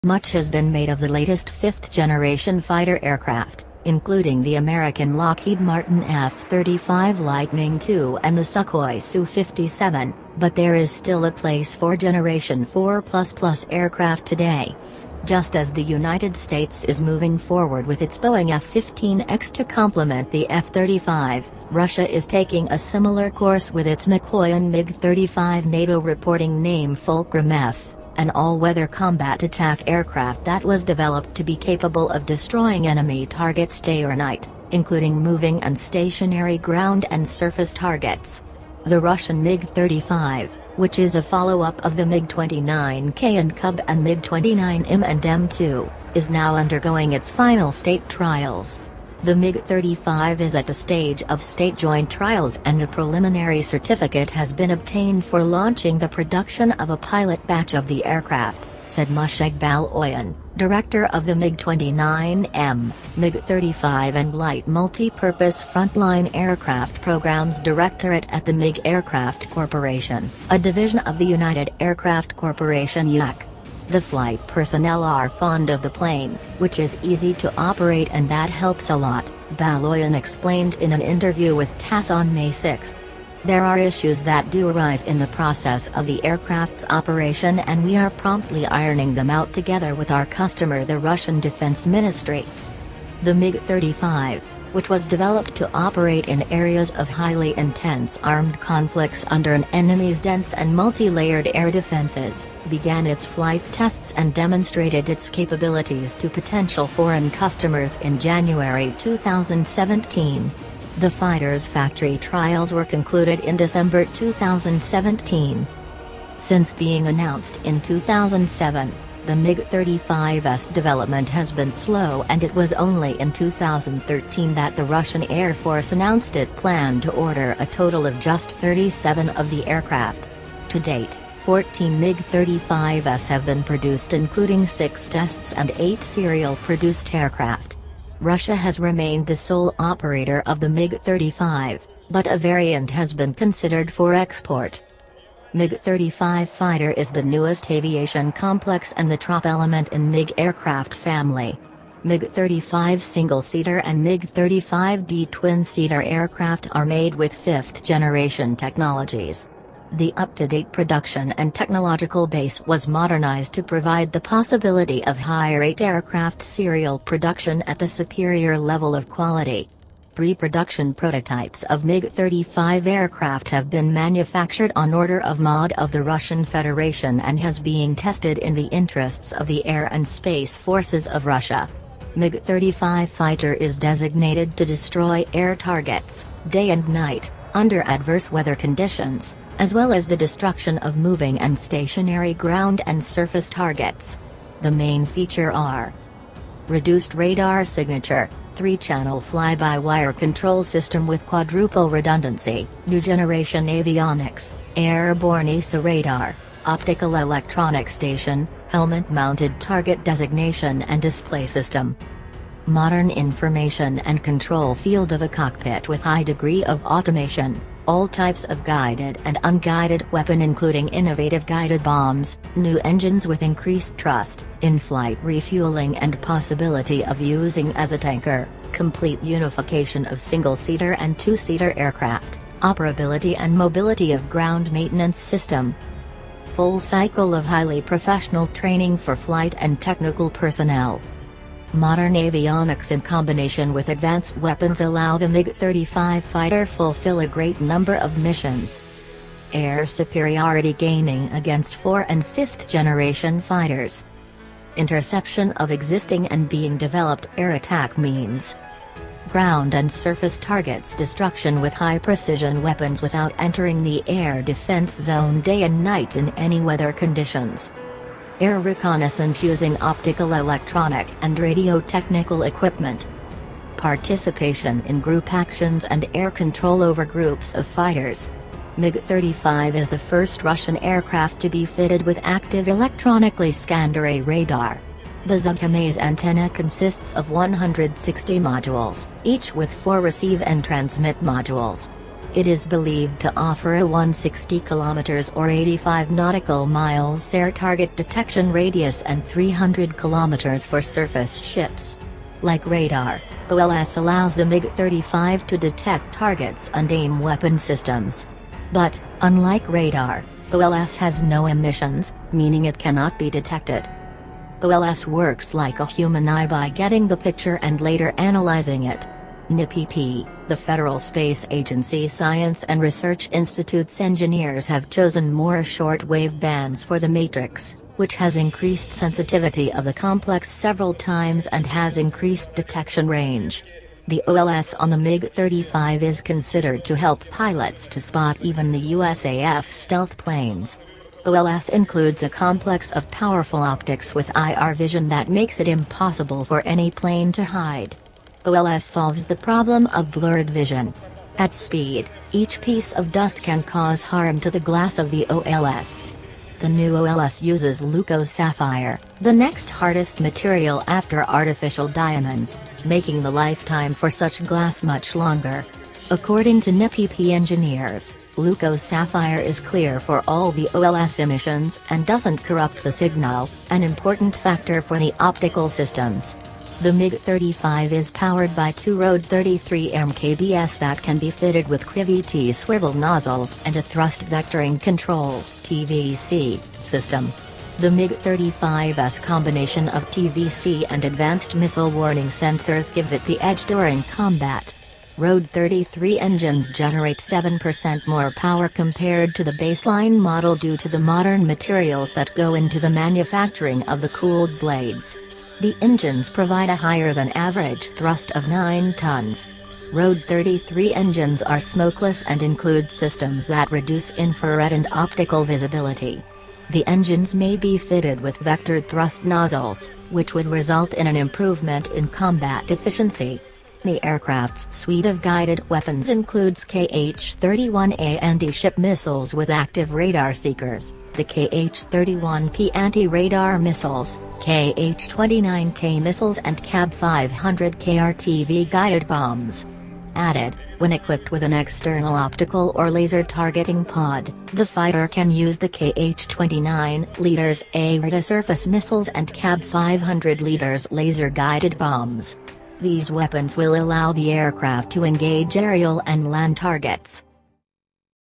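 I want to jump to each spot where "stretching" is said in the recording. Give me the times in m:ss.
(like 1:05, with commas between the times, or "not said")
not said.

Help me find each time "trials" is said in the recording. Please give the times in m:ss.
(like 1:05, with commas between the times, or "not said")
0:48, 0:52, 1:52.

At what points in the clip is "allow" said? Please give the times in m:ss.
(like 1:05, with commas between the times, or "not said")
4:04, 5:03, 7:33.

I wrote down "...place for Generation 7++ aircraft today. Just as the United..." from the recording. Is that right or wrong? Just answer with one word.
wrong.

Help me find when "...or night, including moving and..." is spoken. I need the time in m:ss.
0:34.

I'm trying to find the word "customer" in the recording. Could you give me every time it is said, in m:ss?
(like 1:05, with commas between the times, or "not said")
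1:30, 1:47.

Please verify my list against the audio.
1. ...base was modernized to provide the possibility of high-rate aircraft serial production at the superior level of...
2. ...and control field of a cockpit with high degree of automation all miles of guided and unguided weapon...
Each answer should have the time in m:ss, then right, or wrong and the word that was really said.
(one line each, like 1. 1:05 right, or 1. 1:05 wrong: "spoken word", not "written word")
1. 2:42 right
2. 3:33 wrong: "types", not "miles".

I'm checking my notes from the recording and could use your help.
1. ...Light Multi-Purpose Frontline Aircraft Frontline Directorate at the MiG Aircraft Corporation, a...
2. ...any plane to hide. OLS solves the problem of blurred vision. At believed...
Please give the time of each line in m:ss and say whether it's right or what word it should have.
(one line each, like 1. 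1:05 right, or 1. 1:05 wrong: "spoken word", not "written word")
1. 1:04 wrong: "Programs", not "Frontline"
2. 5:46 wrong: "speed", not "believed".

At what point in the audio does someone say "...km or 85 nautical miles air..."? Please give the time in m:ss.
4:54.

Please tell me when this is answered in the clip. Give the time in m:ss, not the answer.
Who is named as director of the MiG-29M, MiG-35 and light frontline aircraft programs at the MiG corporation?
0:59.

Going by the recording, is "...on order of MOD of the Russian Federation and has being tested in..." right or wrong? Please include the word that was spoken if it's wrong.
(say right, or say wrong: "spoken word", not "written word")
right.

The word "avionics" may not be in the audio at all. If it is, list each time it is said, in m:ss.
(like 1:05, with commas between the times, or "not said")
3:23, 4:02.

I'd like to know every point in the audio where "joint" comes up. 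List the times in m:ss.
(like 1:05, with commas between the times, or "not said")
0:51.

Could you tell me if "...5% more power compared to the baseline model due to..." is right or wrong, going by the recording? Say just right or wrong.
wrong.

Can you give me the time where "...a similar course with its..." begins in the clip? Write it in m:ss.
0:22.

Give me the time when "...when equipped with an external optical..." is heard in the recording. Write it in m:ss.
7:20.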